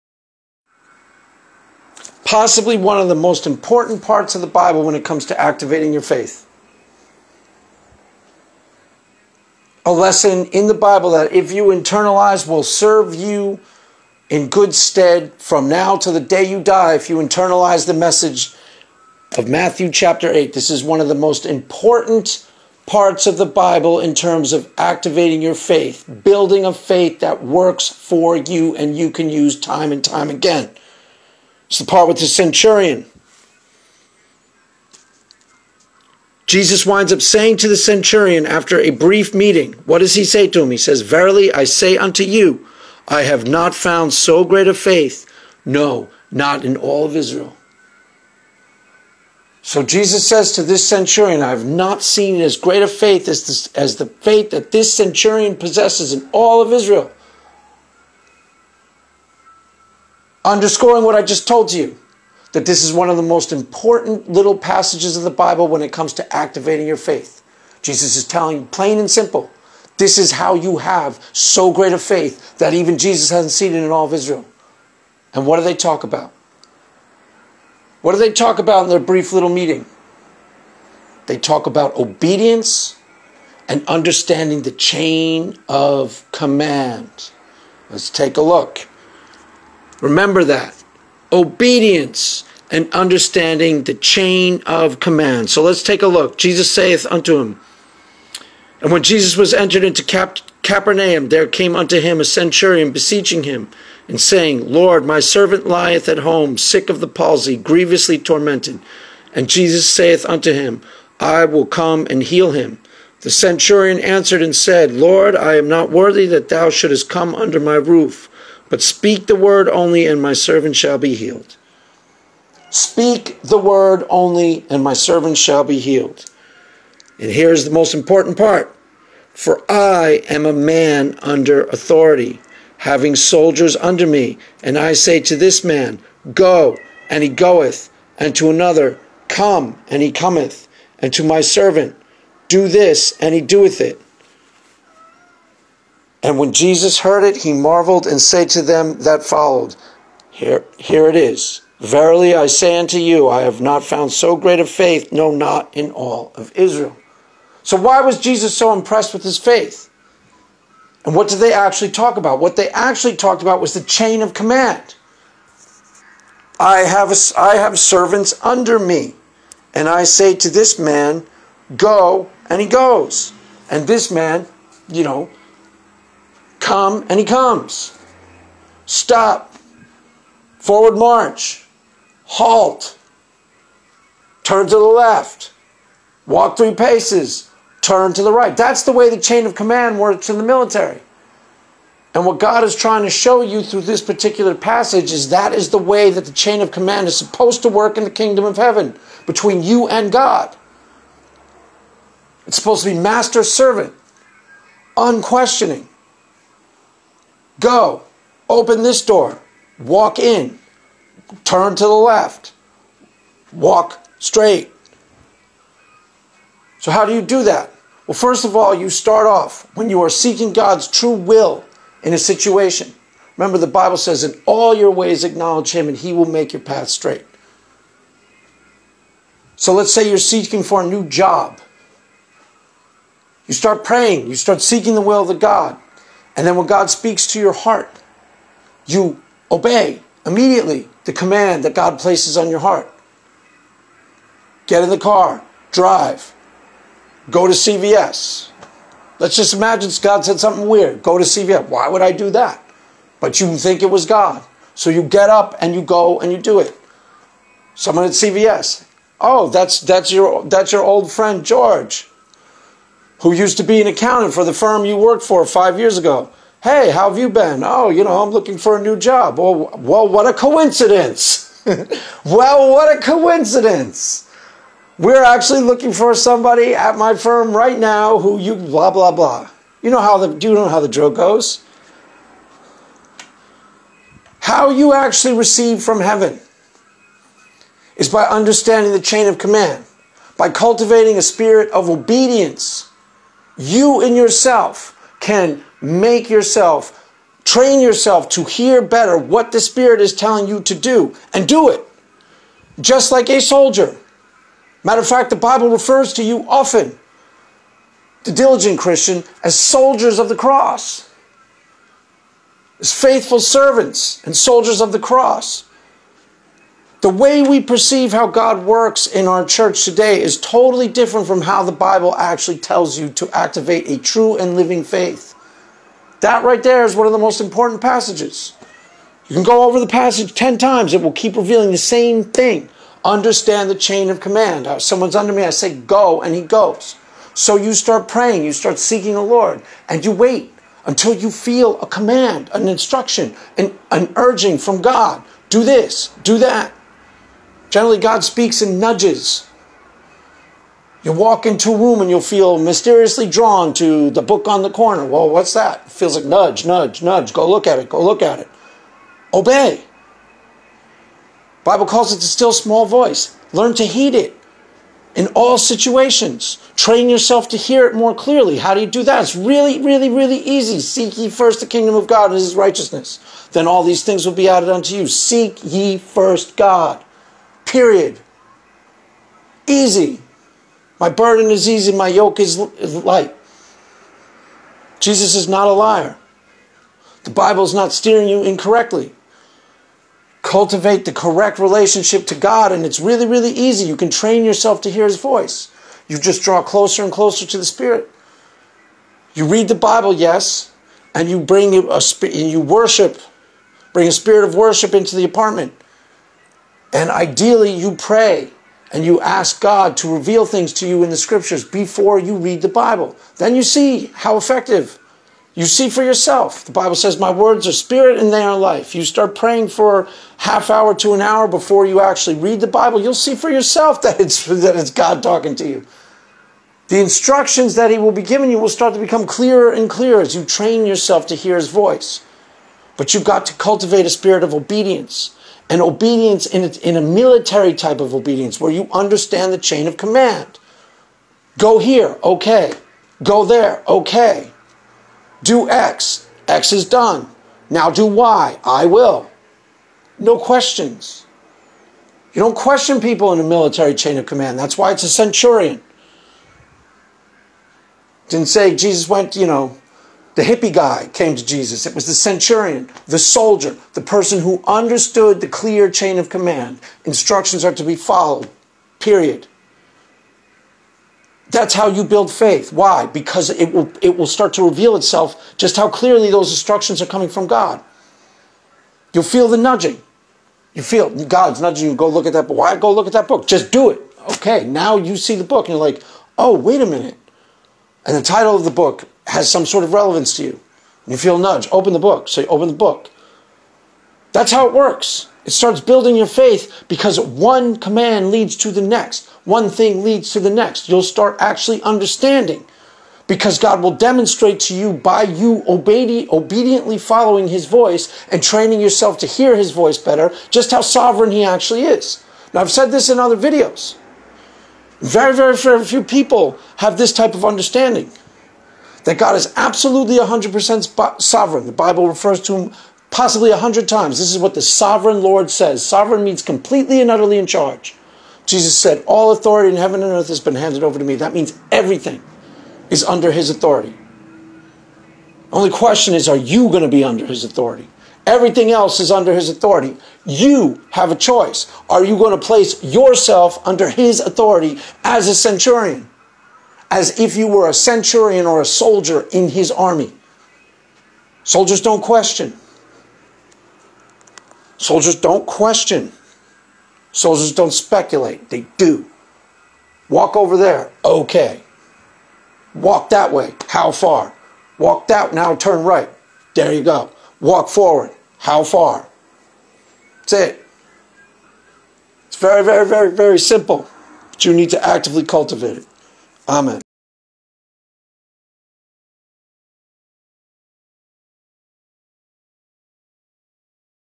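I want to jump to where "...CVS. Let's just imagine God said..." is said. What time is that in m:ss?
4:07.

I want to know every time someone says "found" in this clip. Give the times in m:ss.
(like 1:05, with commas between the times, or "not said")
0:43, 2:33.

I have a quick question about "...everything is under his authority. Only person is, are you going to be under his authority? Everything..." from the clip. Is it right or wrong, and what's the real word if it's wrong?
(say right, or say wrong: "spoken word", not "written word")
wrong: "question", not "person".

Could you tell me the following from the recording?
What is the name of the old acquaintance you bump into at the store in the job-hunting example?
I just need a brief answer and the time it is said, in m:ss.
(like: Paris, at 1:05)
George, at 4:21.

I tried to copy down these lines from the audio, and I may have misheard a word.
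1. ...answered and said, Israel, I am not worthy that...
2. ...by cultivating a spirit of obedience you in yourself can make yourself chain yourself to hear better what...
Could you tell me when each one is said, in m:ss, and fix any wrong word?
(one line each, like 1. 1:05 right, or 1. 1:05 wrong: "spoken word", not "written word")
1. 1:53 wrong: "Lord", not "Israel"
2. 4:50 wrong: "train", not "chain".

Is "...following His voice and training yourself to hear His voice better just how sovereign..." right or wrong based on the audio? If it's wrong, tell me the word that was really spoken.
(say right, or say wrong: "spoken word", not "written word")
right.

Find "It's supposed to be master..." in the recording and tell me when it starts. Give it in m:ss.
3:22.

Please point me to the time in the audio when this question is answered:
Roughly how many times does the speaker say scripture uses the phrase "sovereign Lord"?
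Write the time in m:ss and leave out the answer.
8:43.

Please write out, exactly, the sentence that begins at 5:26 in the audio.
That right there is one of the most important passages.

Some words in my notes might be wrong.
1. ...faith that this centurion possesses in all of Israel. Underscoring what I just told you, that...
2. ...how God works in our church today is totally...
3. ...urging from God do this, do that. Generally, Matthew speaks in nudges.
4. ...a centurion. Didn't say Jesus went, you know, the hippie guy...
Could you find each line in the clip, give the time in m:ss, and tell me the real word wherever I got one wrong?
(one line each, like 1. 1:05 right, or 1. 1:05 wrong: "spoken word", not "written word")
1. 0:54 right
2. 5:18 right
3. 5:44 wrong: "God", not "Matthew"
4. 7:35 right.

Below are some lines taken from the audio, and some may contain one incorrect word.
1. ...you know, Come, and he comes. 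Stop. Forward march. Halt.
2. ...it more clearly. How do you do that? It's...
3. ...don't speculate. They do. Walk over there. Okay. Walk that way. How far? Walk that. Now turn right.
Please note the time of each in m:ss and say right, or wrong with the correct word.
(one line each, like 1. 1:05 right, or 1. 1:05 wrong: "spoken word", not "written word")
1. 2:54 right
2. 6:07 right
3. 9:17 right.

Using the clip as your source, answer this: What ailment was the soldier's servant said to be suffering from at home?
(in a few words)
Palsy.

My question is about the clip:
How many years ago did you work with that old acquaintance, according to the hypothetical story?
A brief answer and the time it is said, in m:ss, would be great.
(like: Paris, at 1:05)
5, at 4:25.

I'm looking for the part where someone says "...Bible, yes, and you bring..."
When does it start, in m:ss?
6:39.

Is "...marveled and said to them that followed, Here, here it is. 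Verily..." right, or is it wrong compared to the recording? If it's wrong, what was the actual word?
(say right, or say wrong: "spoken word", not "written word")
right.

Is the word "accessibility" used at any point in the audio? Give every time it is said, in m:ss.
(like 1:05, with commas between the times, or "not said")
not said.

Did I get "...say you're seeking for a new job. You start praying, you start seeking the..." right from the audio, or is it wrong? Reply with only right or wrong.
right.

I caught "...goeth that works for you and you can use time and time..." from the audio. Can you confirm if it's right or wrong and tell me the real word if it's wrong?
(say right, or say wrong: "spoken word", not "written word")
wrong: "faith", not "goeth".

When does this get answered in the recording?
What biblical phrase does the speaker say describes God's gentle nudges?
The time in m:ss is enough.
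6:02.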